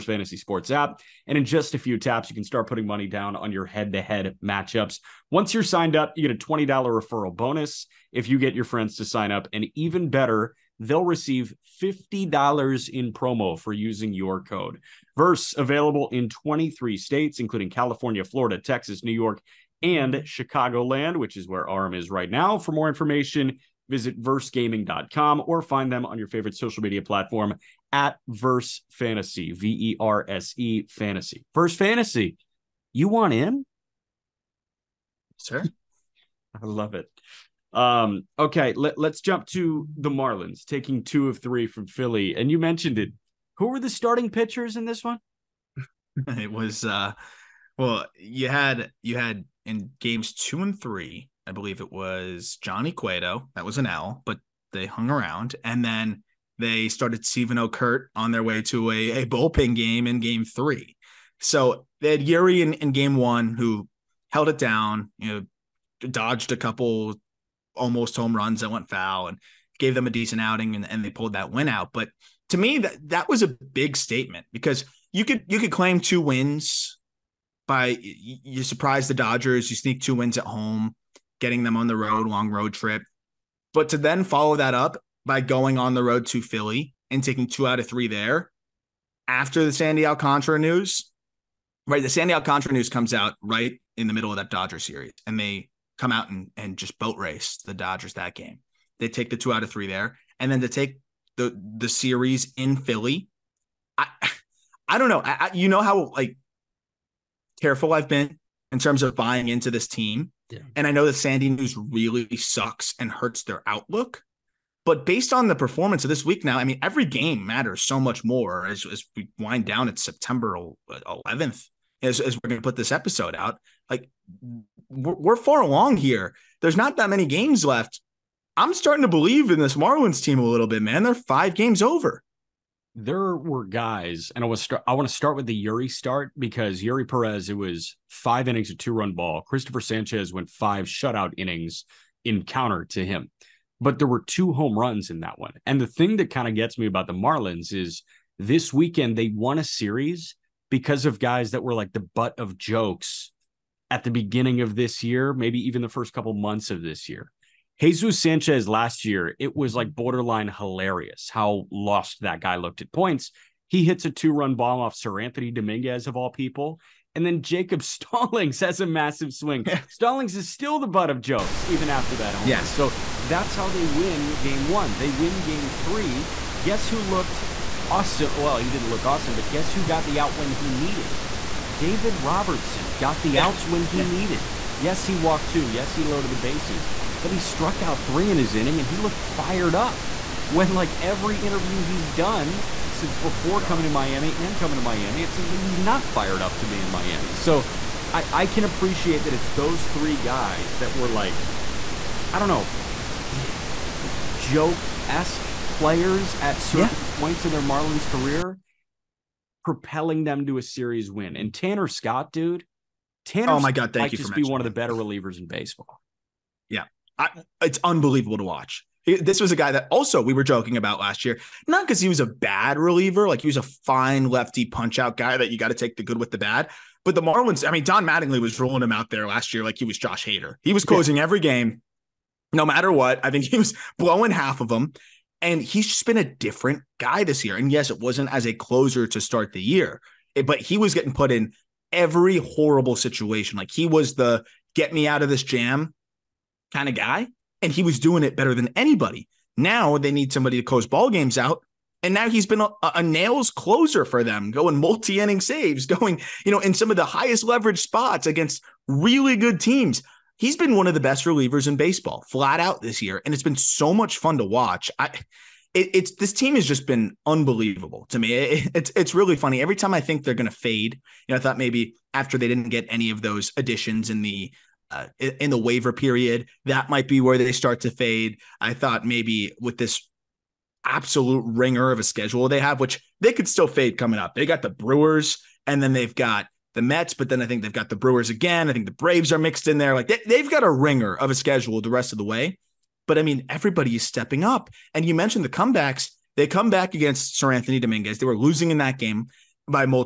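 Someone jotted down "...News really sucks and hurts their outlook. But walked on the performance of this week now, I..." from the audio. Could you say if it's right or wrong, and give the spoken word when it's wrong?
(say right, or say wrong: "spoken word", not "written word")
wrong: "based", not "walked".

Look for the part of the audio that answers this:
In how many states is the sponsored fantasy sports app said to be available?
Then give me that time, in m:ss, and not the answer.
0:16.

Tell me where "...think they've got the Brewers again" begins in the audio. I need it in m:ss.
4:47.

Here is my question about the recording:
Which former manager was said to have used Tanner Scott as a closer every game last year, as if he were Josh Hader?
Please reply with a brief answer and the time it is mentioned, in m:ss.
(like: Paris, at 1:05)
Don Mattingly, at 3:47.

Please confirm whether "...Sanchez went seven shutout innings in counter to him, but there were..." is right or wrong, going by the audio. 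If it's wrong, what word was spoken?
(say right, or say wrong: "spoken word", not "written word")
wrong: "five", not "seven".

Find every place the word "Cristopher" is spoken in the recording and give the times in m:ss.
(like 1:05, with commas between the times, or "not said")
2:19.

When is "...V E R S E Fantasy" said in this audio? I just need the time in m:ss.
0:29.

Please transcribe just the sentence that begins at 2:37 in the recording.
Jesus Sanchez last year, it was like borderline hilarious how lost that guy looked at points.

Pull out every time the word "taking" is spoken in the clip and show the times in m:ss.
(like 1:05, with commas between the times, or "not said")
0:40, 1:27.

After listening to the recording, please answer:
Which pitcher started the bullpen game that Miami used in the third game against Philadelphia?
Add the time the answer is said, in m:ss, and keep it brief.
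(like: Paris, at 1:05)
Steven Okert, at 0:57.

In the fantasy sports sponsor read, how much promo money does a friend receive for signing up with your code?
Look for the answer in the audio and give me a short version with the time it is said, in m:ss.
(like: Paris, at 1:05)
$50, at 0:11.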